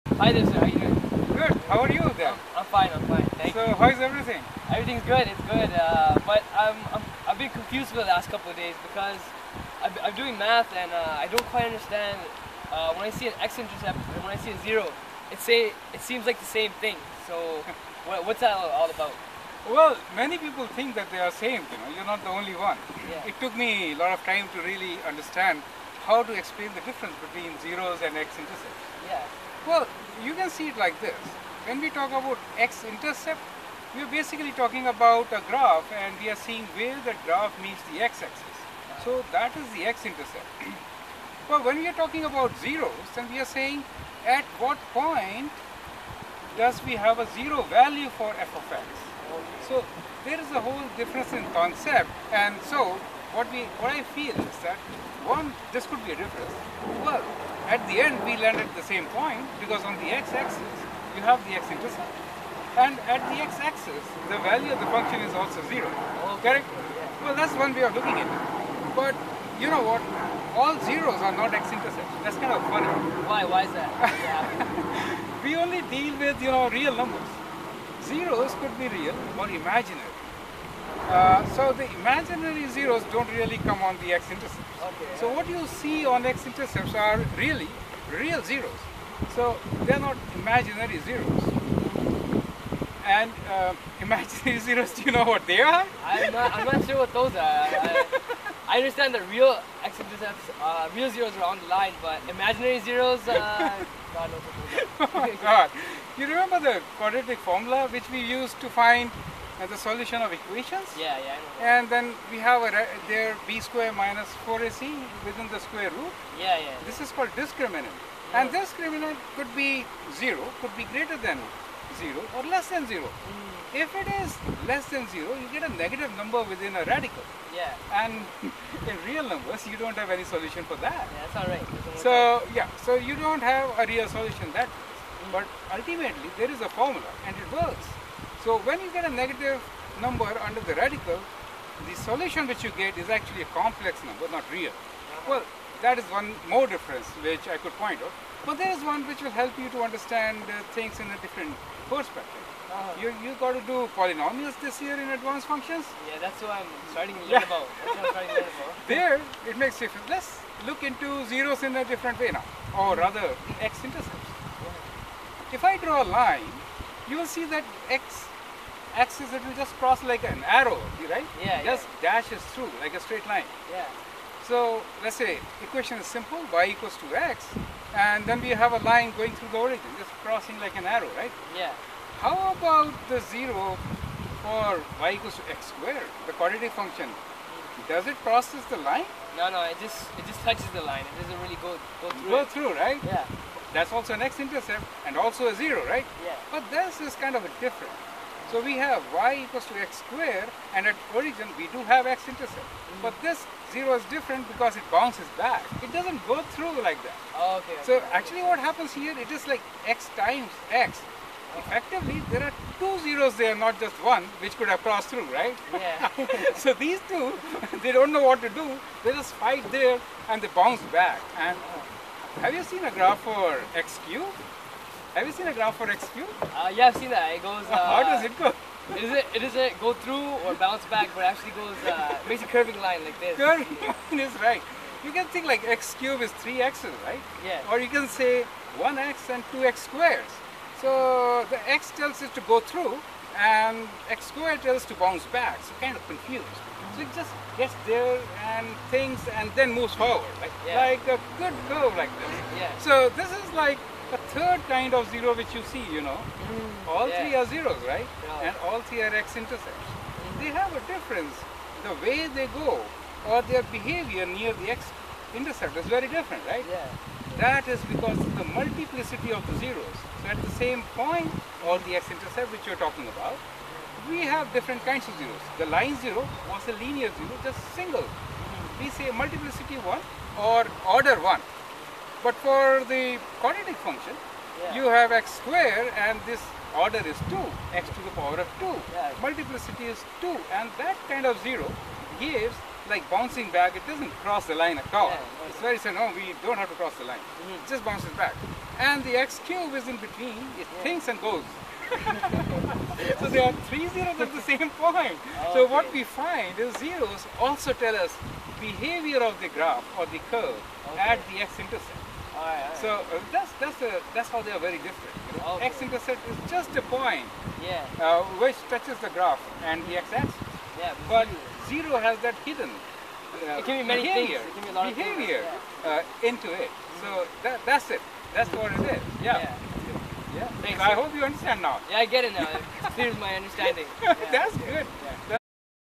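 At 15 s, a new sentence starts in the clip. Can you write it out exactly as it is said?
It say it seems like the same thing.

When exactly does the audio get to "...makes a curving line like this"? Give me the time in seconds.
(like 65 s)
232 s.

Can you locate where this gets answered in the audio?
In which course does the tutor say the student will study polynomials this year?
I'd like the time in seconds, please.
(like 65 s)
155 s.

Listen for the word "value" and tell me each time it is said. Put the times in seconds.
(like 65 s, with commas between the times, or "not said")
47 s, 64 s.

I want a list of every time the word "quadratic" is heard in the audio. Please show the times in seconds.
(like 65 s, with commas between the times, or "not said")
106 s, 186 s, 283 s.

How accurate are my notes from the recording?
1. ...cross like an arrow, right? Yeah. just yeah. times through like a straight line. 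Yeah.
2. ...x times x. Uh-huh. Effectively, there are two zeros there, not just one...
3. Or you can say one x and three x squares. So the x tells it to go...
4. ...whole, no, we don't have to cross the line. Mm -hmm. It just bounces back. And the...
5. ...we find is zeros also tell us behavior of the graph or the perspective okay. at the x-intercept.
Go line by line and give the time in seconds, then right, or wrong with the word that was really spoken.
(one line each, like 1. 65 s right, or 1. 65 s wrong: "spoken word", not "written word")
1. 169 s wrong: "dashes", not "times"
2. 209 s right
3. 237 s wrong: "two", not "three"
4. 295 s wrong: "simple", not "whole"
5. 305 s wrong: "curve", not "perspective".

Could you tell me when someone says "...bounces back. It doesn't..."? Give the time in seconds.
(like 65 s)
204 s.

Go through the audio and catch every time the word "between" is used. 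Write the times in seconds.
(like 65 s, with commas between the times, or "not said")
27 s, 300 s.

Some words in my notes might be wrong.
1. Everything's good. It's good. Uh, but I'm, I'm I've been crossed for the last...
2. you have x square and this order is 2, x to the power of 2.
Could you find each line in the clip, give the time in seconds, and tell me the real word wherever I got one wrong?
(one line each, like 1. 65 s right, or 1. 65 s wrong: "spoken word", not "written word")
1. 4 s wrong: "confused", not "crossed"
2. 284 s right.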